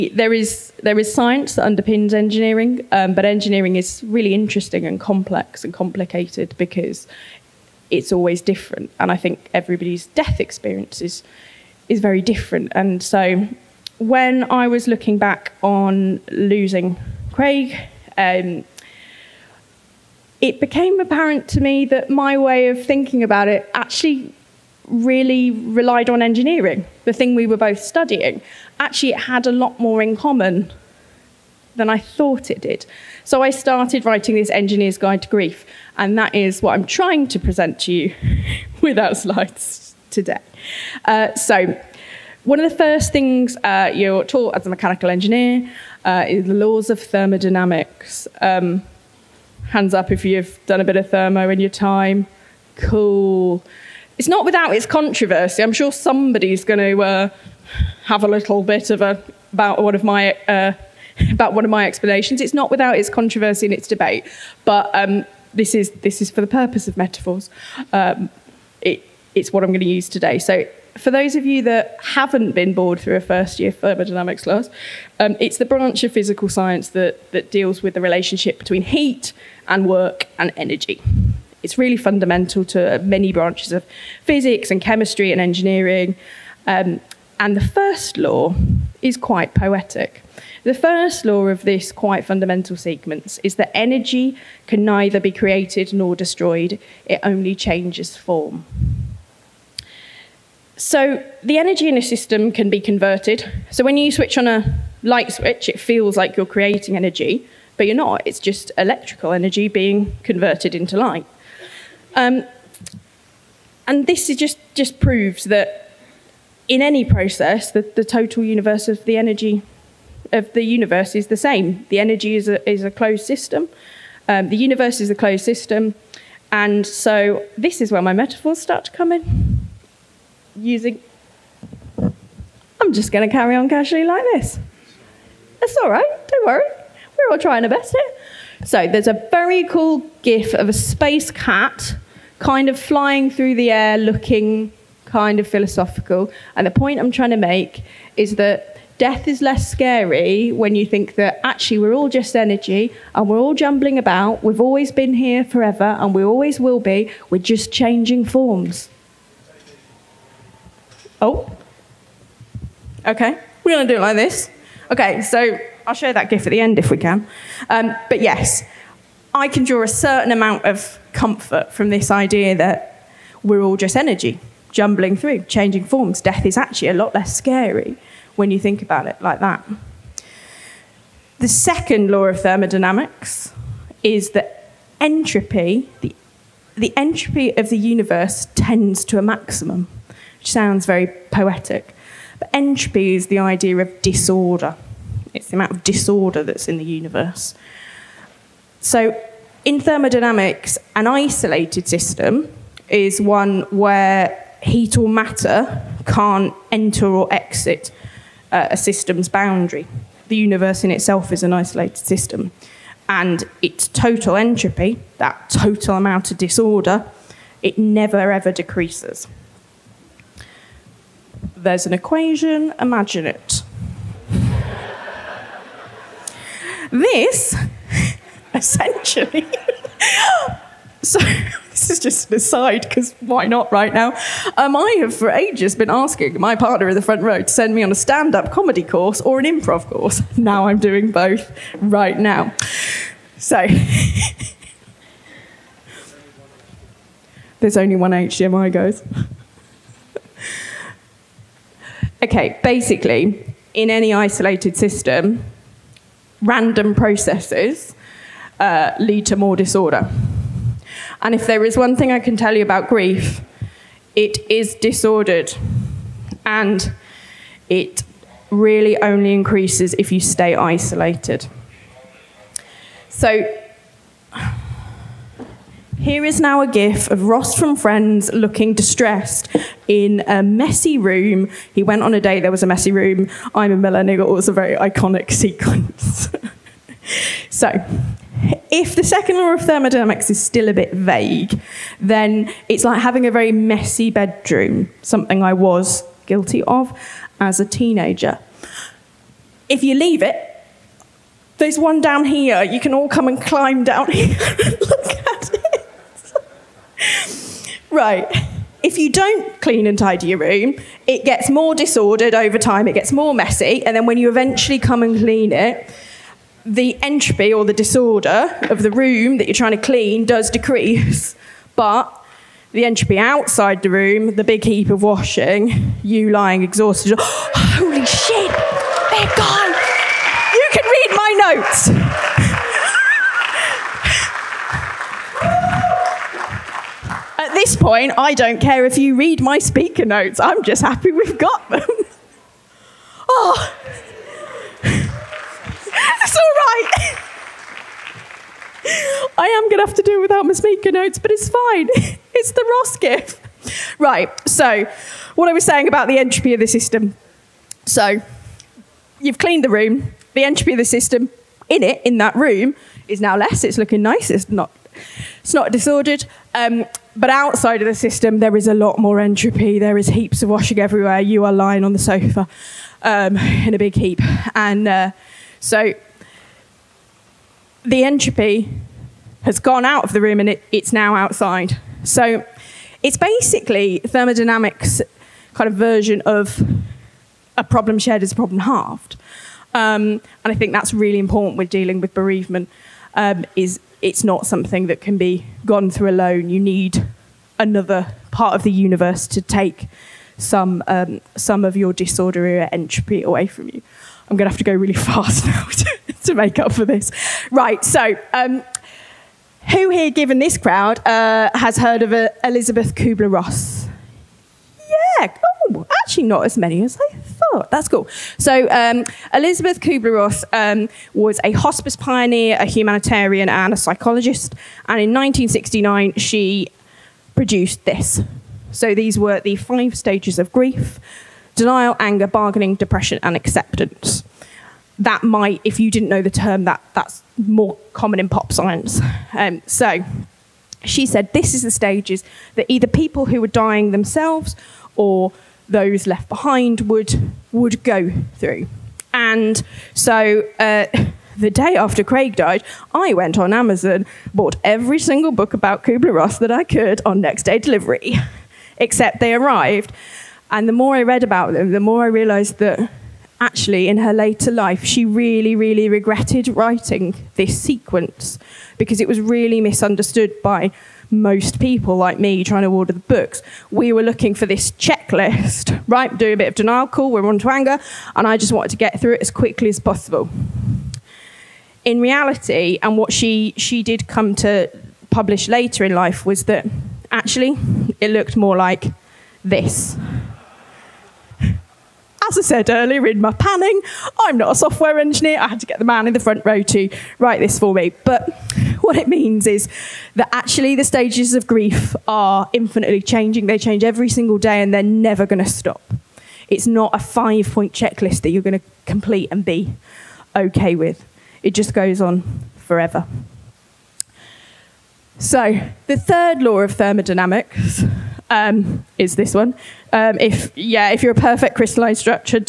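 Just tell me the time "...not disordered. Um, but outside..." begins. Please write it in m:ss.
6:05.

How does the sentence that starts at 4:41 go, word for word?
He went on a date, there was a messy room.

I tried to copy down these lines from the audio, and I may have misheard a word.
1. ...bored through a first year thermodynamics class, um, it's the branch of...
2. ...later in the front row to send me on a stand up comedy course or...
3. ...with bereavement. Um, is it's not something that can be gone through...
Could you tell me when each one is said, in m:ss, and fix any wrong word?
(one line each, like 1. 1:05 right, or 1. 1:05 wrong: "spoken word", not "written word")
1. 1:12 right
2. 3:56 wrong: "partner", not "later"
3. 6:31 right.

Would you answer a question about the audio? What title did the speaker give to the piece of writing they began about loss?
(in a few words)
engineer's guide to grief.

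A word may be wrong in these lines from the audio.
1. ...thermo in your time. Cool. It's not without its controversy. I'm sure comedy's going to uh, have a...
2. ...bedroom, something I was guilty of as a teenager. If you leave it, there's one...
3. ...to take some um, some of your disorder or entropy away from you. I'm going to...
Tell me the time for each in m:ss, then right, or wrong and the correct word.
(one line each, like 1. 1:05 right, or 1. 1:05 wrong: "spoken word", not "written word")
1. 0:51 wrong: "somebody", not "comedy"
2. 4:54 right
3. 6:39 right.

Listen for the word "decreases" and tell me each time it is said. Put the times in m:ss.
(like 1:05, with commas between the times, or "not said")
3:38, 5:20.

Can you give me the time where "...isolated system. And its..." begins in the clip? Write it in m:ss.
3:31.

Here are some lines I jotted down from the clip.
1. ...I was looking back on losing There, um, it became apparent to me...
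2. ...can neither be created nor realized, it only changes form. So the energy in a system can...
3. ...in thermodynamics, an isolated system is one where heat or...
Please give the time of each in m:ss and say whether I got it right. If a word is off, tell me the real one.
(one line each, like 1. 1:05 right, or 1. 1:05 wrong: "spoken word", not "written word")
1. 0:14 wrong: "Craig", not "There"
2. 1:34 wrong: "destroyed", not "realized"
3. 3:19 right.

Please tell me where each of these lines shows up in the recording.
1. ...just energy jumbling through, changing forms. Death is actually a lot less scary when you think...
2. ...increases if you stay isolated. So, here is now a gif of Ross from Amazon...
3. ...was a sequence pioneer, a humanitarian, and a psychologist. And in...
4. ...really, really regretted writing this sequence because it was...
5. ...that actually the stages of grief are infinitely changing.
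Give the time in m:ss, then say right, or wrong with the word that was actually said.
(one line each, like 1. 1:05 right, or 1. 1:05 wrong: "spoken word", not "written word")
1. 2:53 right
2. 4:29 wrong: "Friends", not "Amazon"
3. 7:01 wrong: "hospice", not "sequence"
4. 7:45 right
5. 8:20 right.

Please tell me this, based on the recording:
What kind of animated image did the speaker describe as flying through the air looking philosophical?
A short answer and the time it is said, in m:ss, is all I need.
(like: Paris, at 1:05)
a space cat, at 2:20.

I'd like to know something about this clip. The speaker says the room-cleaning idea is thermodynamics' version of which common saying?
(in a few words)
a problem shared is a problem halved.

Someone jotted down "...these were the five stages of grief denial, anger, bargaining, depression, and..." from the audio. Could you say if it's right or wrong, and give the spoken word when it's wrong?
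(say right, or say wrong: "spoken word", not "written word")
right.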